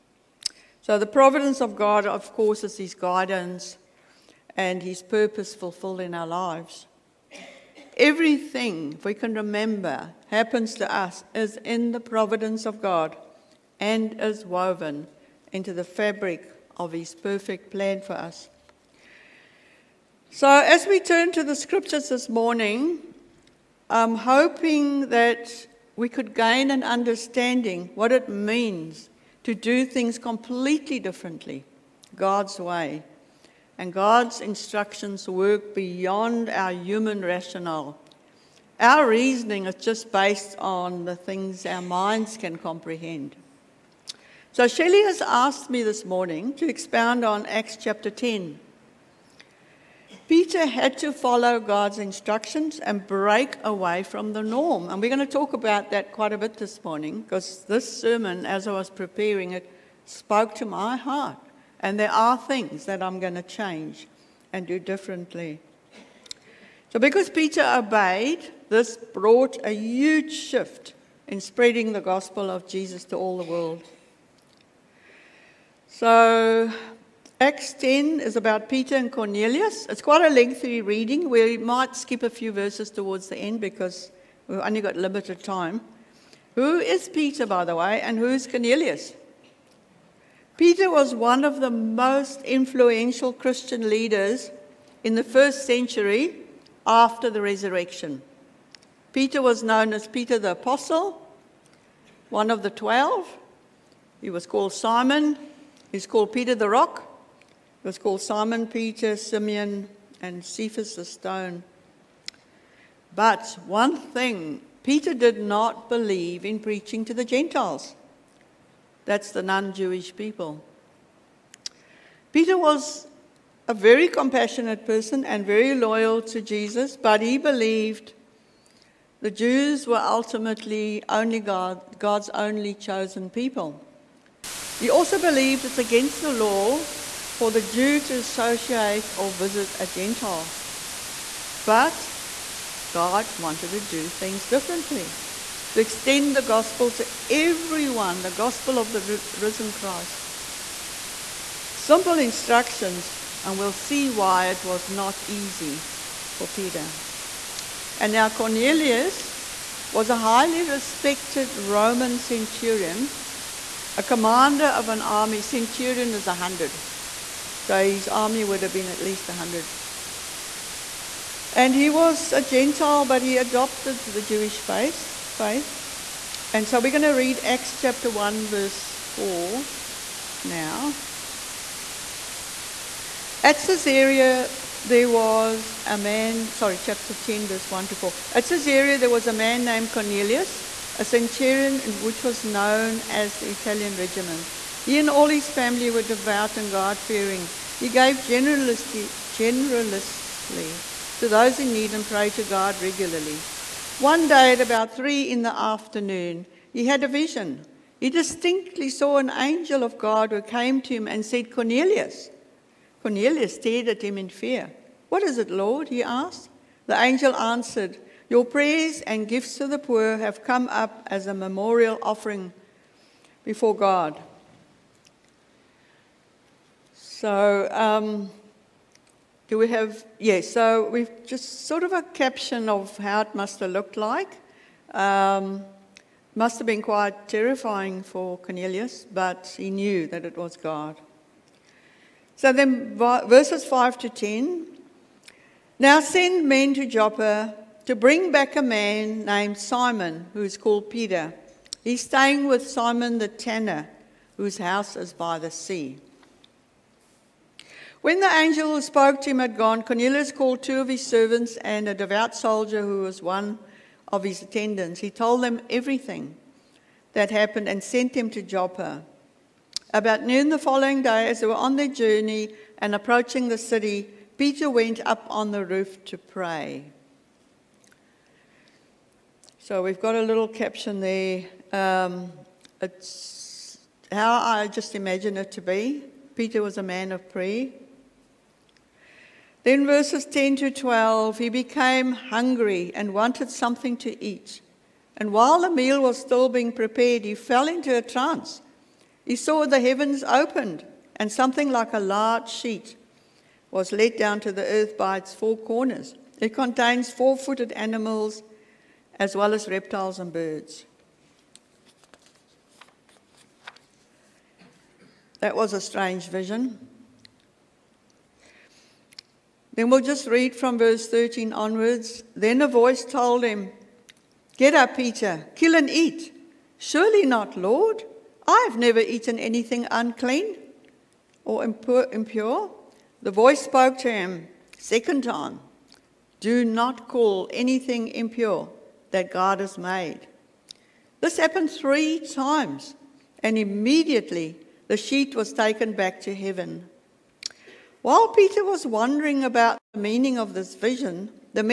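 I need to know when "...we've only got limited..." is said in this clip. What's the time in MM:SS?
01:24.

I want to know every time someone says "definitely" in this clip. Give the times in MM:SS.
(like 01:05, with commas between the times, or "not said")
not said.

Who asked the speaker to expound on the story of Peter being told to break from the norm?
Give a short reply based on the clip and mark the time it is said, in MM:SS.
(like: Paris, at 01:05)
Shelley, at 00:44.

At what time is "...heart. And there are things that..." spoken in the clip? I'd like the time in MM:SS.
01:00.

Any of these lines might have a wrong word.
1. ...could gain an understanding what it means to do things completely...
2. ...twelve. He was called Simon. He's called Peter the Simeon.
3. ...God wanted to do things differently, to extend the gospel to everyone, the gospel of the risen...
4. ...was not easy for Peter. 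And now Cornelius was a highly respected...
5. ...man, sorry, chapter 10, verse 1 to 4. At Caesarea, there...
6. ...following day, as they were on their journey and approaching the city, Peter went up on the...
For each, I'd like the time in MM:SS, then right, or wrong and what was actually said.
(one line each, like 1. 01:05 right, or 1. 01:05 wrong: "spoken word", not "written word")
1. 00:26 right
2. 01:42 wrong: "Rock", not "Simeon"
3. 02:22 right
4. 02:34 right
5. 03:05 right
6. 04:30 right.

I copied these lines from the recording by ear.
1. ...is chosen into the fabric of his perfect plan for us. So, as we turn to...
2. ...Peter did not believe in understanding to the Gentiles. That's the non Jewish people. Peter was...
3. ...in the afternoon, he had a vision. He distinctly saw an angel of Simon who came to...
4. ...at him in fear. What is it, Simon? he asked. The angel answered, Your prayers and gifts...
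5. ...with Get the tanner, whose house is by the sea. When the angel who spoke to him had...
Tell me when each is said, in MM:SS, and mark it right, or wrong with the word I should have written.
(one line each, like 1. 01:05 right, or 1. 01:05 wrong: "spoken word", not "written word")
1. 00:14 wrong: "woven", not "chosen"
2. 01:54 wrong: "preaching", not "understanding"
3. 03:25 wrong: "God", not "Simon"
4. 03:33 wrong: "Lord", not "Simon"
5. 04:12 wrong: "Simon", not "Get".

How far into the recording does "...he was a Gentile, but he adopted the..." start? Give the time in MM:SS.
02:51.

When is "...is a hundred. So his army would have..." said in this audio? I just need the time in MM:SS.
02:46.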